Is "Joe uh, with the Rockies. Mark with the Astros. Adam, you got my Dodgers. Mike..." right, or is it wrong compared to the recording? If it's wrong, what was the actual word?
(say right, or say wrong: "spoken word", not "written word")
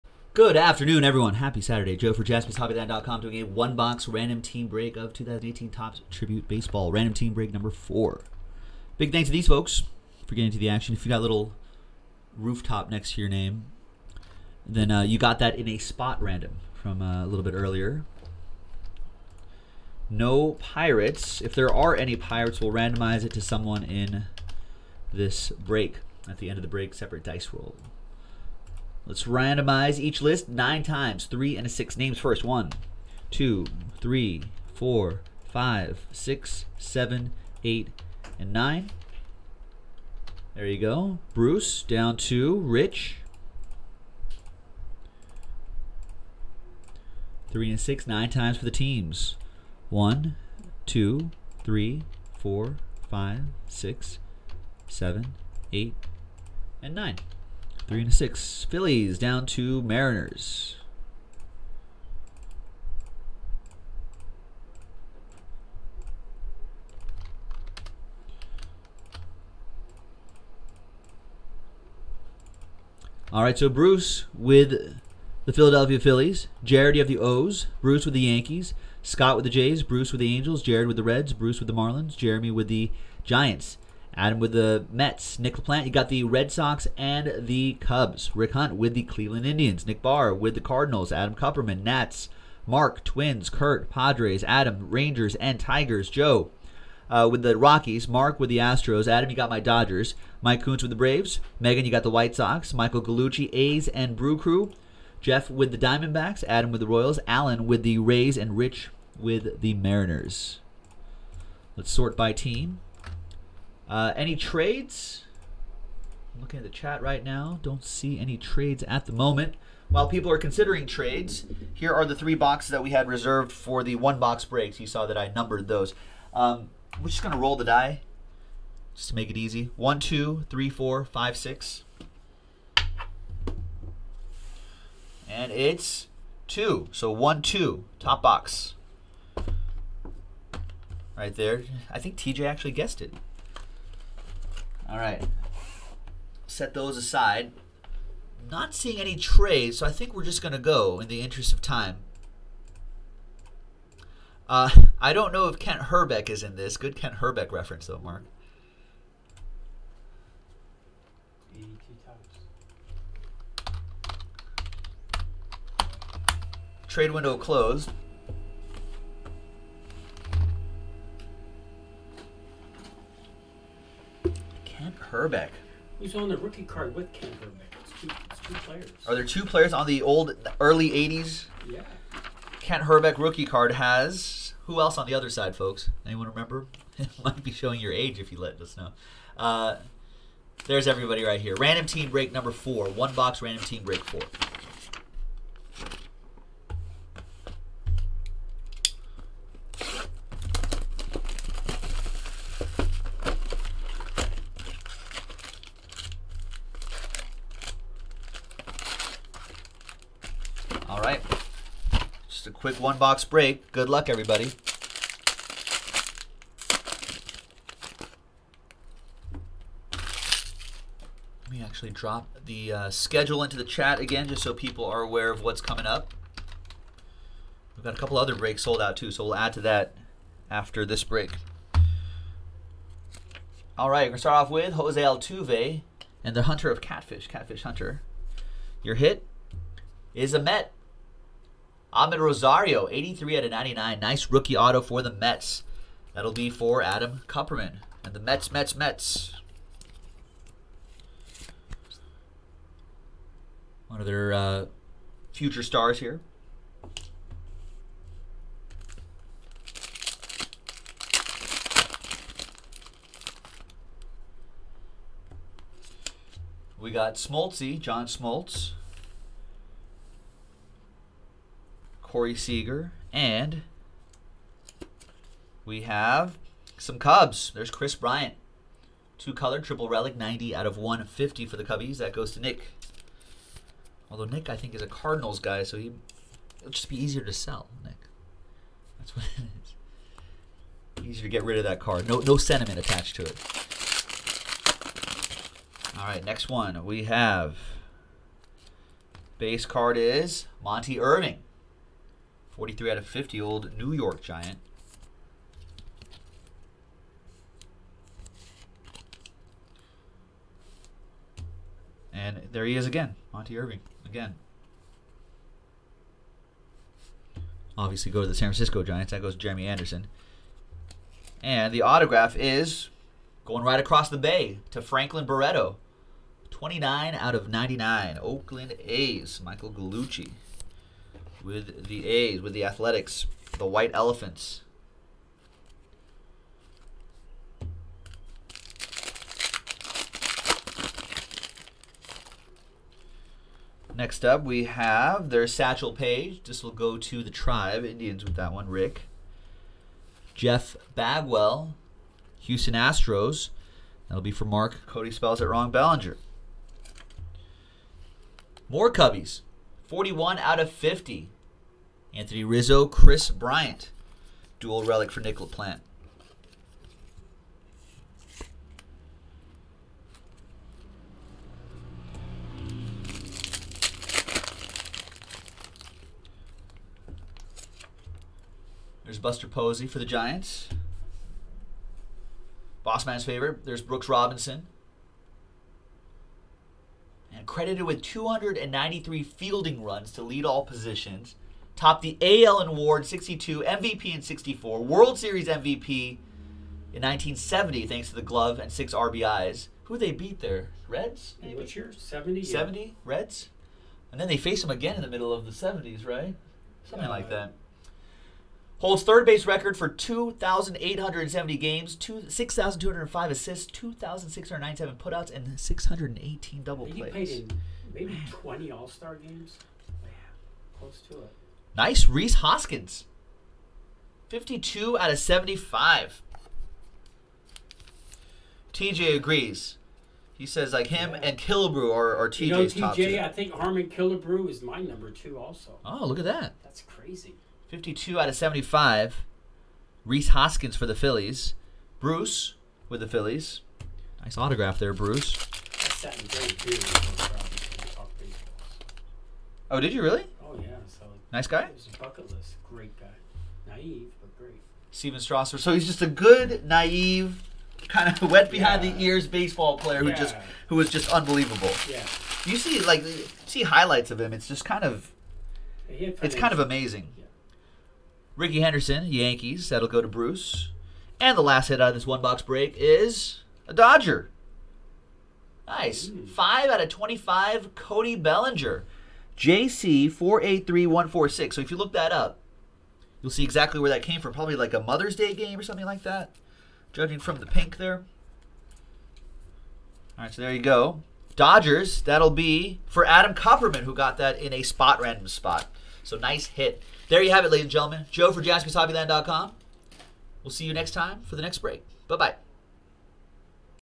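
right.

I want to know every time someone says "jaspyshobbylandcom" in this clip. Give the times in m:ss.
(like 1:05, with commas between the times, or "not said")
0:02, 8:18.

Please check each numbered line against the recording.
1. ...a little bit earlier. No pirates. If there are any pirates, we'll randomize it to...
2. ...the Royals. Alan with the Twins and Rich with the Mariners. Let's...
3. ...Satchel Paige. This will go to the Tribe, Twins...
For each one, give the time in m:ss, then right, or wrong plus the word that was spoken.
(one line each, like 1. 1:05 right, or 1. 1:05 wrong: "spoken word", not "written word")
1. 0:17 right
2. 1:46 wrong: "Rays", not "Twins"
3. 5:45 wrong: "Indians", not "Twins".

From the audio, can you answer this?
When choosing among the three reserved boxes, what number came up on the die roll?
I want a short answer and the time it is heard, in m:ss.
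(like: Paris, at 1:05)
2, at 2:15.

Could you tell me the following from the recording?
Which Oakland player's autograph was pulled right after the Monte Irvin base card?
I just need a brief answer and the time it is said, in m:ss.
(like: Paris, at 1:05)
Franklin Barreto, at 5:24.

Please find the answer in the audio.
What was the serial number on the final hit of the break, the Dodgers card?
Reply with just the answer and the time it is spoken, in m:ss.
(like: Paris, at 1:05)
5 out of 25, at 7:56.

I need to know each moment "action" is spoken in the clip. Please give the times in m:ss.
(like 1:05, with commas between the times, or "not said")
0:10.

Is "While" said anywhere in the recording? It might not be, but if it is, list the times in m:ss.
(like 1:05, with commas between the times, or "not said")
1:59.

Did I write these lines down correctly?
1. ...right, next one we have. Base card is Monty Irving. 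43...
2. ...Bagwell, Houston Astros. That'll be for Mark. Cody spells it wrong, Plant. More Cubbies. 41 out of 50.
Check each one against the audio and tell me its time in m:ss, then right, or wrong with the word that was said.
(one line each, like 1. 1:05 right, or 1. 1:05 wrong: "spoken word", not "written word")
1. 4:56 right
2. 5:50 wrong: "Ballinger", not "Plant".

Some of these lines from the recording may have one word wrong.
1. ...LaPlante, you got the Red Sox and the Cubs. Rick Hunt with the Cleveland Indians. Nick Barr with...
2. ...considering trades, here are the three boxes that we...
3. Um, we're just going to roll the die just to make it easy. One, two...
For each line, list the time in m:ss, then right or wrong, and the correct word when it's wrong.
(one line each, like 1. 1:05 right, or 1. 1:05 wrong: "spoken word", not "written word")
1. 1:25 right
2. 2:00 right
3. 2:06 right.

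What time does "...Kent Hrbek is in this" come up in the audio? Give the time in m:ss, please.
2:35.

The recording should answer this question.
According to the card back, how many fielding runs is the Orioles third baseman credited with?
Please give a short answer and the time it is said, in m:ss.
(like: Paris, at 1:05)
293, at 6:28.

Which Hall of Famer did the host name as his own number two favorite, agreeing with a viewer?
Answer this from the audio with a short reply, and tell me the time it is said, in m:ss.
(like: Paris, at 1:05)
Harmon Killebrew, at 7:13.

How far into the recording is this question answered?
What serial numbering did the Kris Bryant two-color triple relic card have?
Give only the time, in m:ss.
4:40.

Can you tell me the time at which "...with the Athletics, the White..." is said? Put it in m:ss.
5:32.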